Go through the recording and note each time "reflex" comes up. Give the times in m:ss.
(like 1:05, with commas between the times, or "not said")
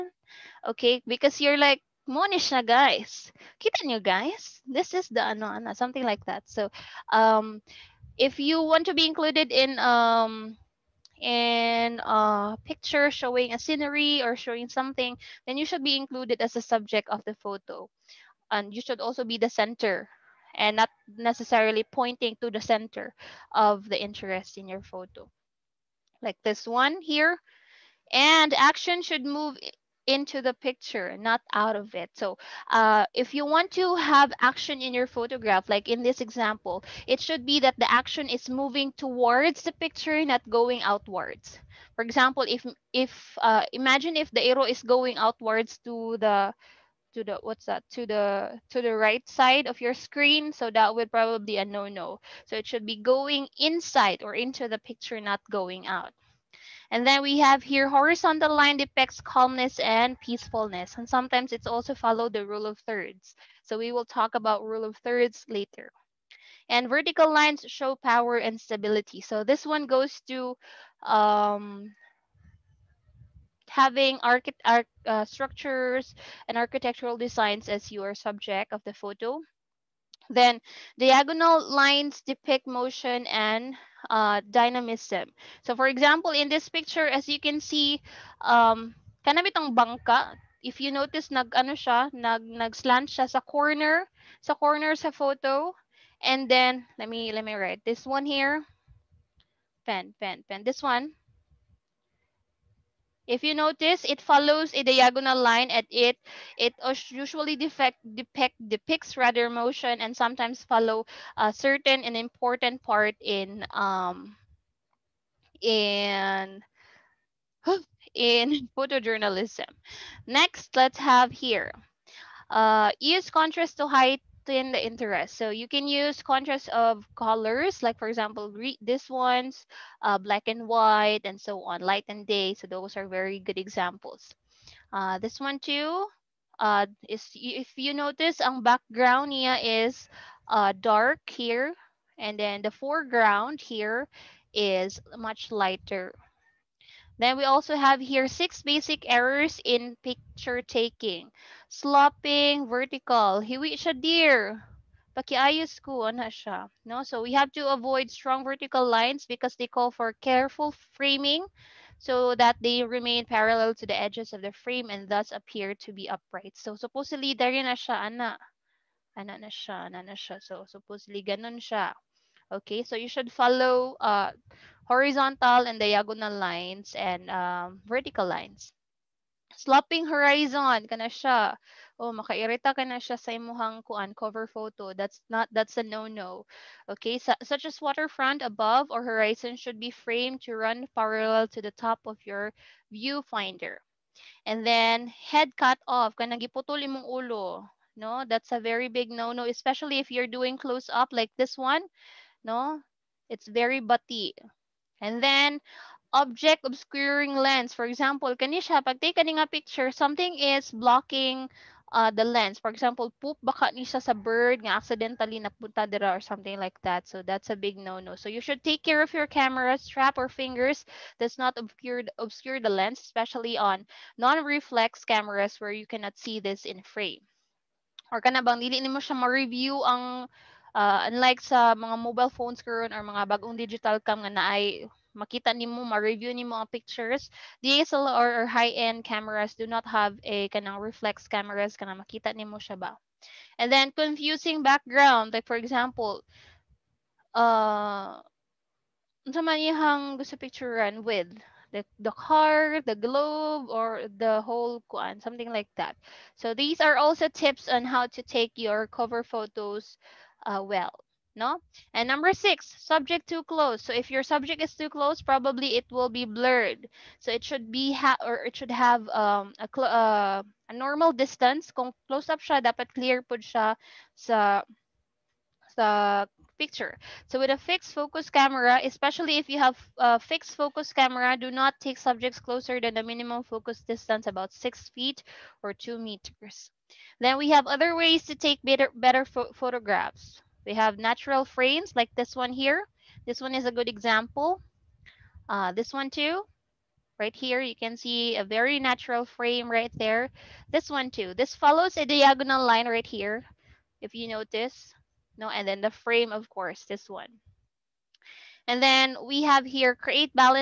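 3:44, 4:00.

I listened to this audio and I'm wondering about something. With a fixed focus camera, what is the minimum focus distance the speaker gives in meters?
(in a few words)
2 meters.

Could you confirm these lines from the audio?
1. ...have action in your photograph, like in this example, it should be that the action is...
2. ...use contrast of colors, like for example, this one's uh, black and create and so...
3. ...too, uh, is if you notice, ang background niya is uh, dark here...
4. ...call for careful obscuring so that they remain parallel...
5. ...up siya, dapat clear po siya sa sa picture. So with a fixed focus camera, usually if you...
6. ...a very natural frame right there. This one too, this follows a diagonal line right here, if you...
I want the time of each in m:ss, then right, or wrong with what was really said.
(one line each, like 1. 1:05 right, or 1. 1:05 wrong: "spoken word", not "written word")
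1. 0:33 right
2. 2:05 wrong: "white", not "create"
3. 2:15 right
4. 2:39 wrong: "framing", not "obscuring"
5. 4:32 wrong: "especially", not "usually"
6. 4:58 right.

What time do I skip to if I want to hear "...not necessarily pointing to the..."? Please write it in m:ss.
0:20.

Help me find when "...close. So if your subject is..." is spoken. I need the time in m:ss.
4:23.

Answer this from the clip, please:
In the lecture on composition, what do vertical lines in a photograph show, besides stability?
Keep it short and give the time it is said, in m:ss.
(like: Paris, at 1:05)
Power, at 1:07.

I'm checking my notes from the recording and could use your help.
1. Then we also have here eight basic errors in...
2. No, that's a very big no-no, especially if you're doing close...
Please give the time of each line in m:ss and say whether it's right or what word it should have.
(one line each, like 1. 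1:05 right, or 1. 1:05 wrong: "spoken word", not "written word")
1. 2:27 wrong: "six", not "eight"
2. 3:17 right.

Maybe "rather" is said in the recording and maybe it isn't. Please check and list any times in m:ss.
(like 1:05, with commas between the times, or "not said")
1:49.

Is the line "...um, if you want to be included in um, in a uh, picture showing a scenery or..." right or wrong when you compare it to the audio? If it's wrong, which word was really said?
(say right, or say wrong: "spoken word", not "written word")
right.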